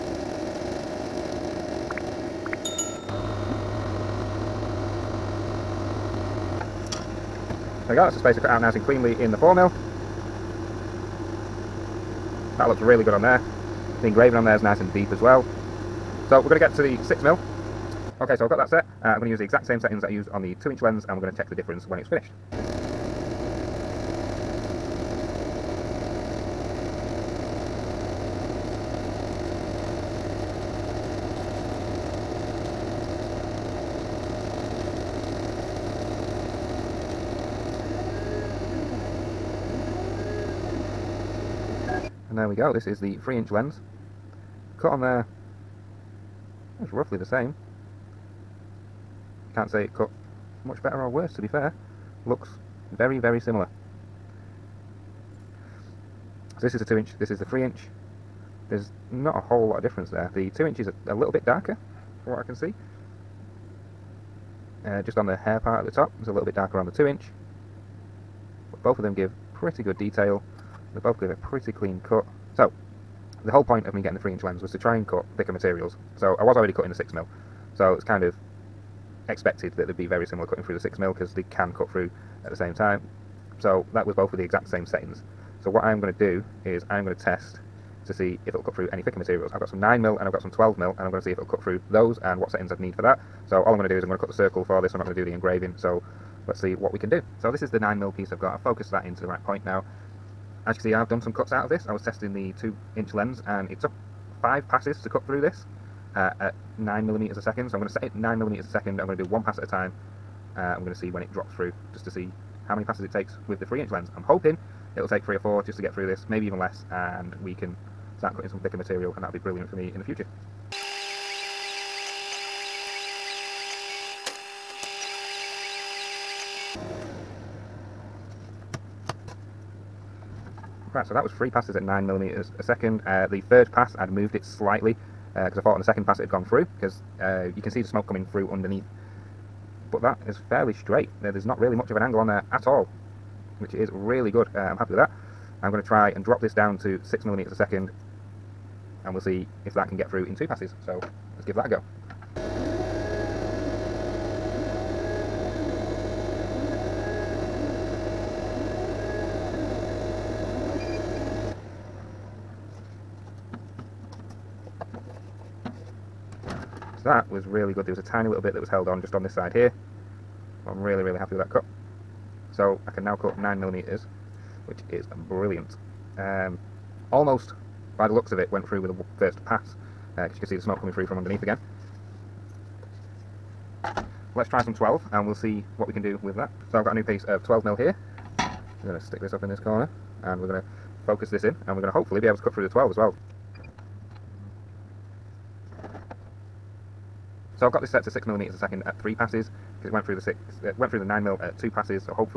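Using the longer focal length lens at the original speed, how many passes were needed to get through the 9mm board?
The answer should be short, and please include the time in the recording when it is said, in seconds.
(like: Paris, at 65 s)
three passes, at 131 s.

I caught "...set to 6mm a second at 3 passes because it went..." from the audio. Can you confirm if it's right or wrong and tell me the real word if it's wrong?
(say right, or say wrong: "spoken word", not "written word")
right.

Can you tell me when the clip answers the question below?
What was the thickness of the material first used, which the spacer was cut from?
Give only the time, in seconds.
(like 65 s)
9 s.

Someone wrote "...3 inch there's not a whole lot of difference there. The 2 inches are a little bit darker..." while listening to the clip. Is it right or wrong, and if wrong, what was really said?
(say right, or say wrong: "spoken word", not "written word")
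right.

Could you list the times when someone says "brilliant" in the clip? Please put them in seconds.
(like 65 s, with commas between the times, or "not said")
119 s, 175 s.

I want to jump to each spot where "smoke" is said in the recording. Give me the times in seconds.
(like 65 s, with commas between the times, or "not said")
137 s, 180 s.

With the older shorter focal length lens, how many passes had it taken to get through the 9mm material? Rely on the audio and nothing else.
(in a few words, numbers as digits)
5 passes.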